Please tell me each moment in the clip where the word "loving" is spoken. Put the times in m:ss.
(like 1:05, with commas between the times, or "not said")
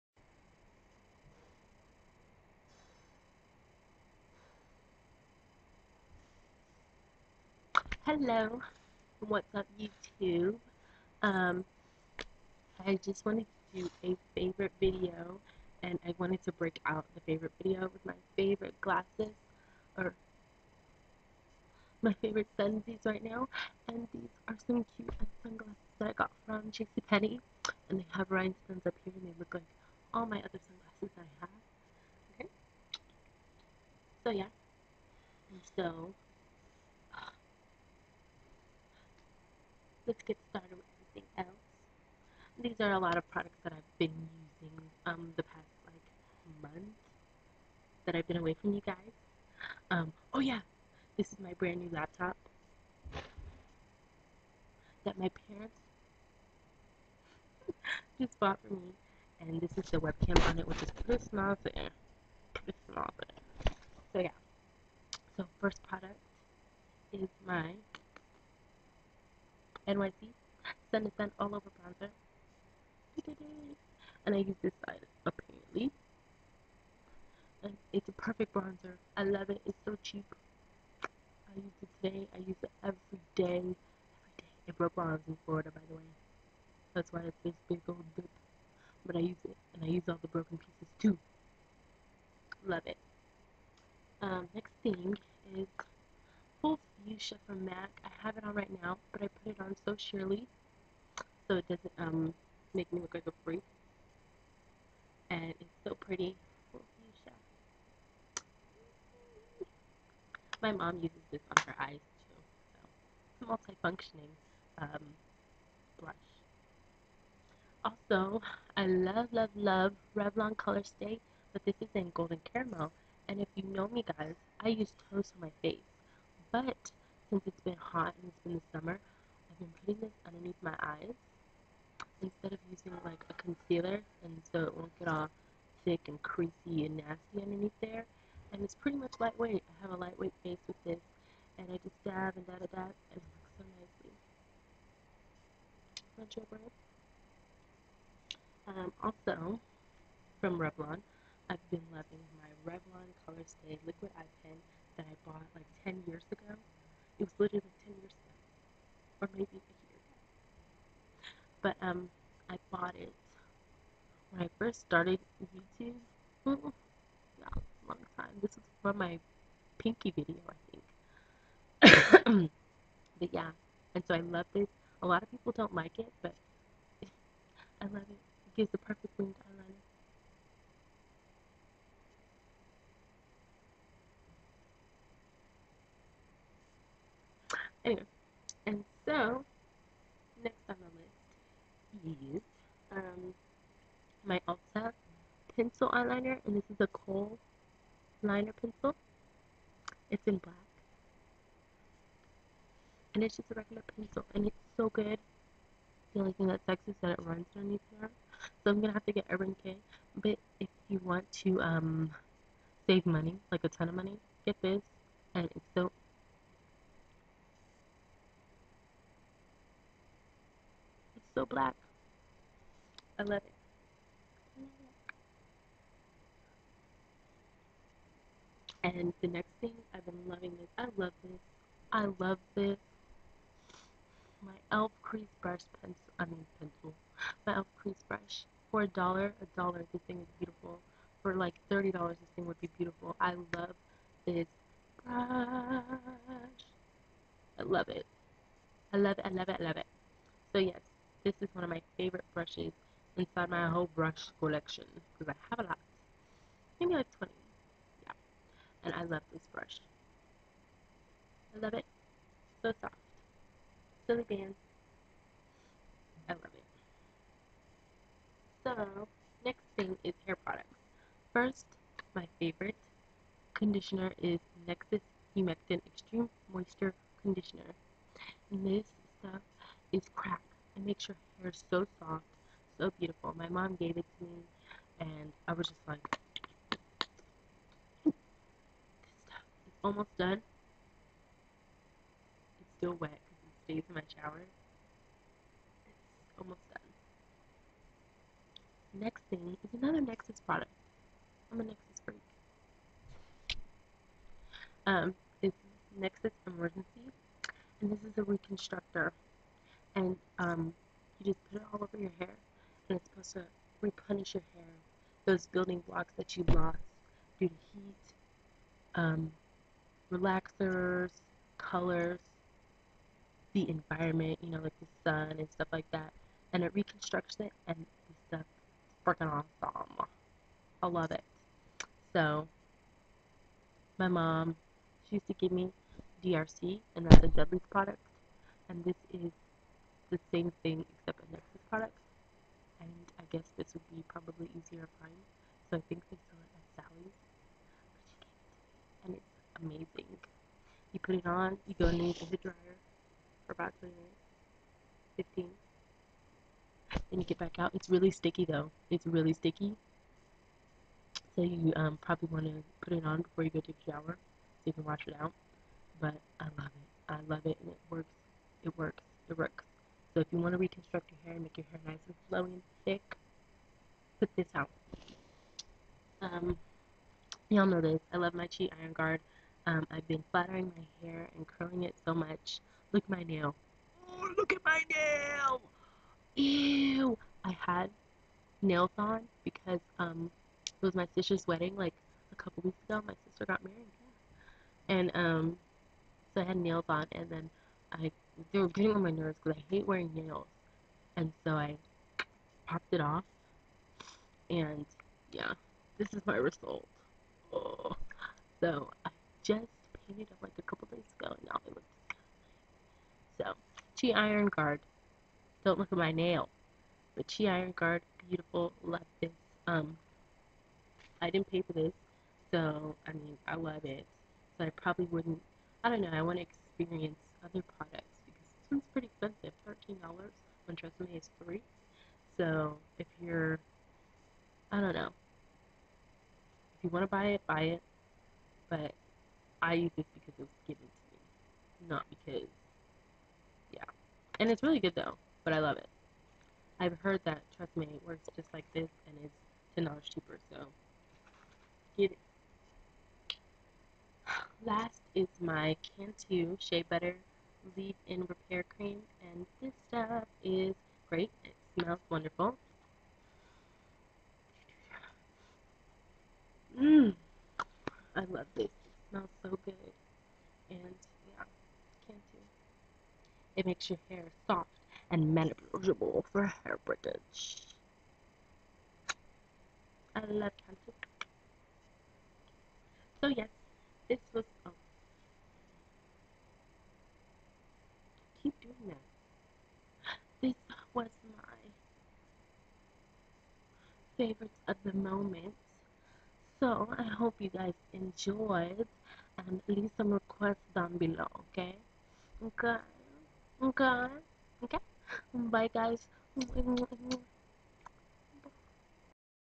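2:31, 3:50.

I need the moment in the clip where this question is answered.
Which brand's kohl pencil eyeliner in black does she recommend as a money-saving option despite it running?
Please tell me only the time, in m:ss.
3:14.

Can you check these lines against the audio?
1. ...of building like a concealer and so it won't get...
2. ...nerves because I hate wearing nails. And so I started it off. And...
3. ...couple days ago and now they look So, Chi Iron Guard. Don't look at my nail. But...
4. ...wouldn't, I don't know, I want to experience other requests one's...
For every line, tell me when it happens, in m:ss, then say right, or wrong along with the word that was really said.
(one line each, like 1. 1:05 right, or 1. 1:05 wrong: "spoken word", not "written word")
1. 2:12 wrong: "using", not "building"
2. 6:39 wrong: "popped", not "started"
3. 6:50 right
4. 7:05 wrong: "products", not "requests".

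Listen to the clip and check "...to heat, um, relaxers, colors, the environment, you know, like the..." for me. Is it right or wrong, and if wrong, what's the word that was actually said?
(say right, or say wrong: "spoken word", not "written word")
right.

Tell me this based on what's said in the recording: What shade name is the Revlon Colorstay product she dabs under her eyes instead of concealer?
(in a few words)
Golden Caramel.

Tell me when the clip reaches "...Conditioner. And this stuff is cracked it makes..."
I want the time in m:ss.
4:37.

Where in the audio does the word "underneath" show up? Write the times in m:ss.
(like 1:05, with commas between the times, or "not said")
2:10, 2:17, 3:27, 5:51.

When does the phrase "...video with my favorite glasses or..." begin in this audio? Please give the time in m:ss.
0:17.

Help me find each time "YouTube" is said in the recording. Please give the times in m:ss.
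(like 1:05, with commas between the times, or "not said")
0:09, 2:45.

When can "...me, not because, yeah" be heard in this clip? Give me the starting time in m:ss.
7:21.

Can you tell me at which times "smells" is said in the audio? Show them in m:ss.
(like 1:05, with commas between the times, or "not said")
7:41, 7:49.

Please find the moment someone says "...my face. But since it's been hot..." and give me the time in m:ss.
2:05.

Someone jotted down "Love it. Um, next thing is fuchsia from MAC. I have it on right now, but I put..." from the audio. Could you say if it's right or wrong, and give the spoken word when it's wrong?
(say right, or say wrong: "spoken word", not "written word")
right.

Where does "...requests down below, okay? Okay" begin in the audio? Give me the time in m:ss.
8:20.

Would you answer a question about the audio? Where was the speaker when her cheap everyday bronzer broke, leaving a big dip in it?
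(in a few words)
Florida.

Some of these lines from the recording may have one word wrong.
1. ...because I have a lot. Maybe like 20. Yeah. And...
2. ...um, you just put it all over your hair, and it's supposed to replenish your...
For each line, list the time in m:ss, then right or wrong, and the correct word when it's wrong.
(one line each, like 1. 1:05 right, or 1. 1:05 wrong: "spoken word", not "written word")
1. 4:15 right
2. 5:10 right.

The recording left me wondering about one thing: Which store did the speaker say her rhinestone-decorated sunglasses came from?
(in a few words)
JCPenney.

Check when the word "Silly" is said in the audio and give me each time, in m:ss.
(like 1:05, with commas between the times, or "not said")
4:24.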